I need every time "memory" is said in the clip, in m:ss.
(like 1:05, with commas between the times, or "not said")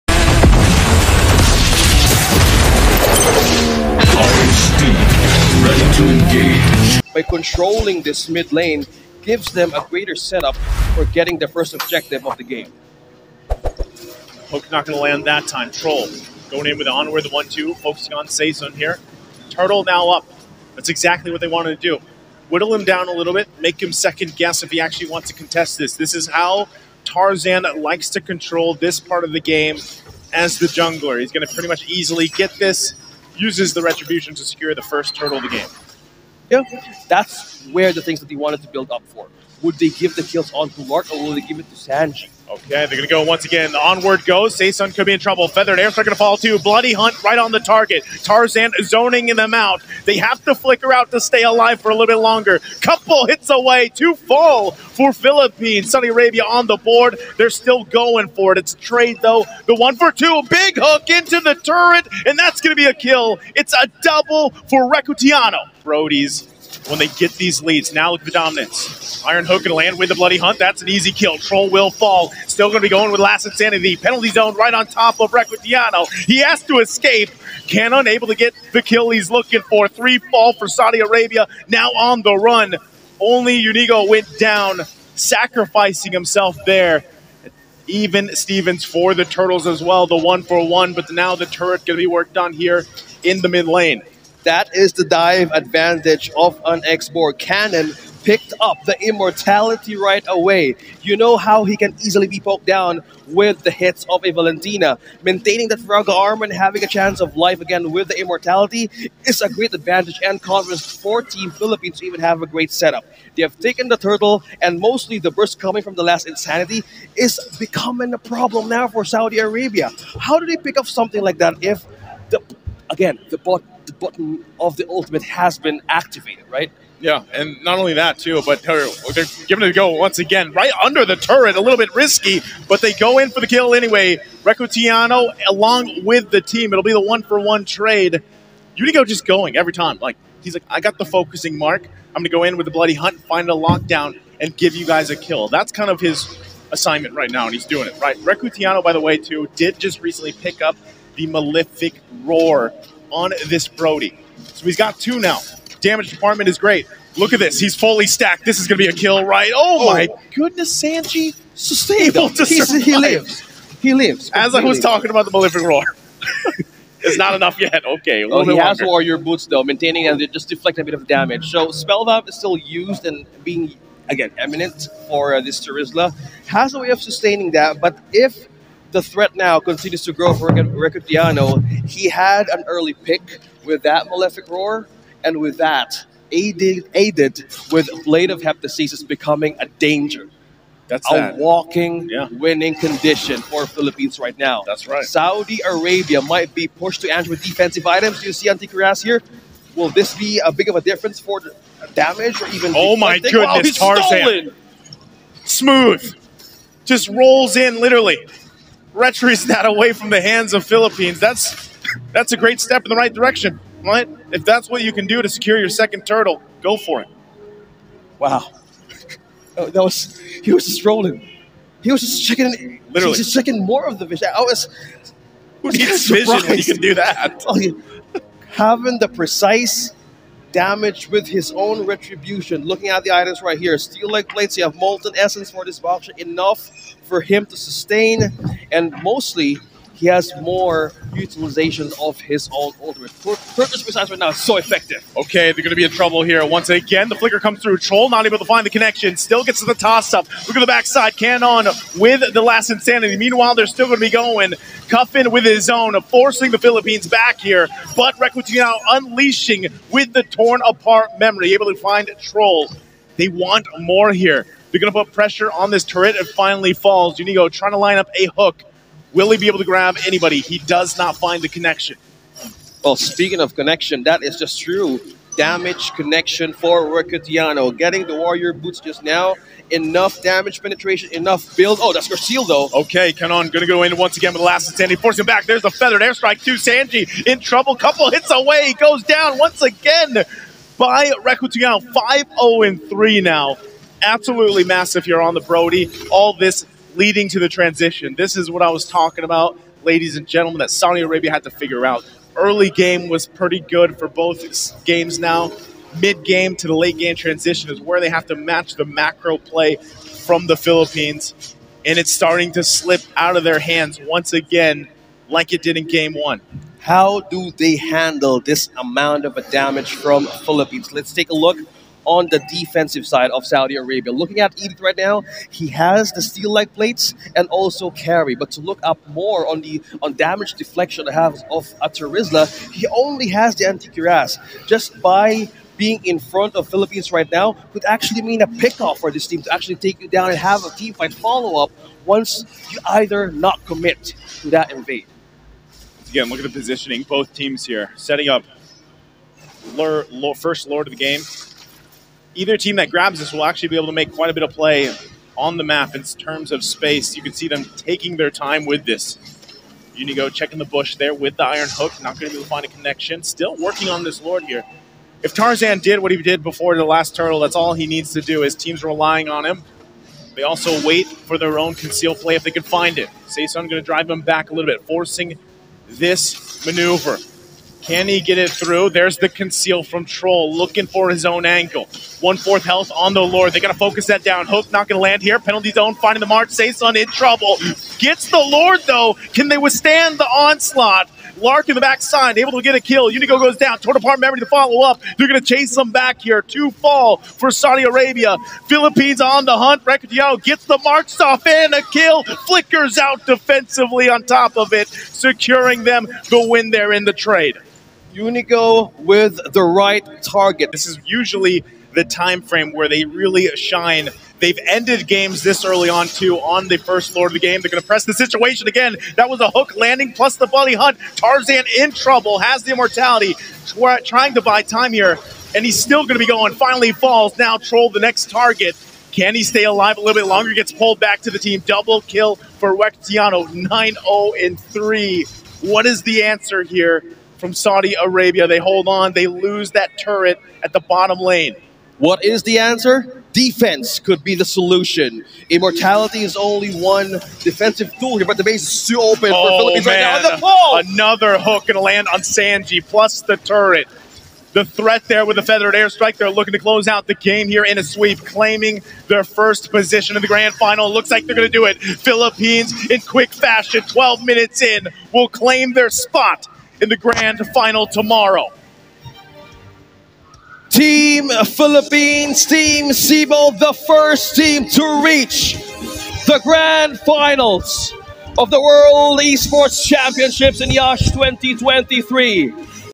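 4:21, 6:34.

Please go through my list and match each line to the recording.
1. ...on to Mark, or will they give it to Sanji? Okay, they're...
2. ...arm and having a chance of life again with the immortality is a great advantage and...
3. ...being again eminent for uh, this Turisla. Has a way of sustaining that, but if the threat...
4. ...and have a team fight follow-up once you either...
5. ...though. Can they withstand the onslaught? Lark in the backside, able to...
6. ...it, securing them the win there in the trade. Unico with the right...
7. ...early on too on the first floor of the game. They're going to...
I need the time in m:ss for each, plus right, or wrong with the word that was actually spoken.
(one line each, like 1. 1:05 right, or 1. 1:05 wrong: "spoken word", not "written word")
1. 0:40 right
2. 1:46 right
3. 2:53 right
4. 5:40 right
5. 6:28 right
6. 6:44 right
7. 6:55 right.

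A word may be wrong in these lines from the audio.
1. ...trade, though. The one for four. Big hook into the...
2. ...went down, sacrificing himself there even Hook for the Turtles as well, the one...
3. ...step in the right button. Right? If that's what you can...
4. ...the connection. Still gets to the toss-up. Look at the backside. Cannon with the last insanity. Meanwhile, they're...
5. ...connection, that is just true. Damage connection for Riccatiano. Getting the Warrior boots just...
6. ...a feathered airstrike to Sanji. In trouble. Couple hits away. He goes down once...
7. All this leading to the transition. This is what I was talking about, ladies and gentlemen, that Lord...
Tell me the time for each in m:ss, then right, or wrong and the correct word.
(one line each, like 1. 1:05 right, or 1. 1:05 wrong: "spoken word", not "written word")
1. 0:58 wrong: "two", not "four"
2. 1:24 wrong: "Stevens", not "Hook"
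3. 3:32 wrong: "direction", not "button"
4. 4:08 right
5. 4:33 right
6. 4:45 right
7. 4:56 wrong: "Saudi", not "Lord".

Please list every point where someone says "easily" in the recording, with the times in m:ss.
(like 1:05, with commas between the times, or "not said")
0:31, 1:42.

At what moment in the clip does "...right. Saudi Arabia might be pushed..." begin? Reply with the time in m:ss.
3:14.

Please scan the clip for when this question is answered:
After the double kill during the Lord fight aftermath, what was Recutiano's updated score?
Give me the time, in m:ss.
7:13.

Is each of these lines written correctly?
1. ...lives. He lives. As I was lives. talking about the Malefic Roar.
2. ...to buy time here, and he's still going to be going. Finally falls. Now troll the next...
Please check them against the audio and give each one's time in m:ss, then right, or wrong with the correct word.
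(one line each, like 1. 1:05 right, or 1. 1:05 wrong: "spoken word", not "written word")
1. 2:42 right
2. 7:04 right.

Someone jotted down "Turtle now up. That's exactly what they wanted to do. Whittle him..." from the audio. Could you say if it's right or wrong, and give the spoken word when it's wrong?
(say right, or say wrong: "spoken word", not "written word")
right.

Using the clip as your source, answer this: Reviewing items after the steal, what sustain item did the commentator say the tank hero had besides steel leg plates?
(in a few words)
Molten essence.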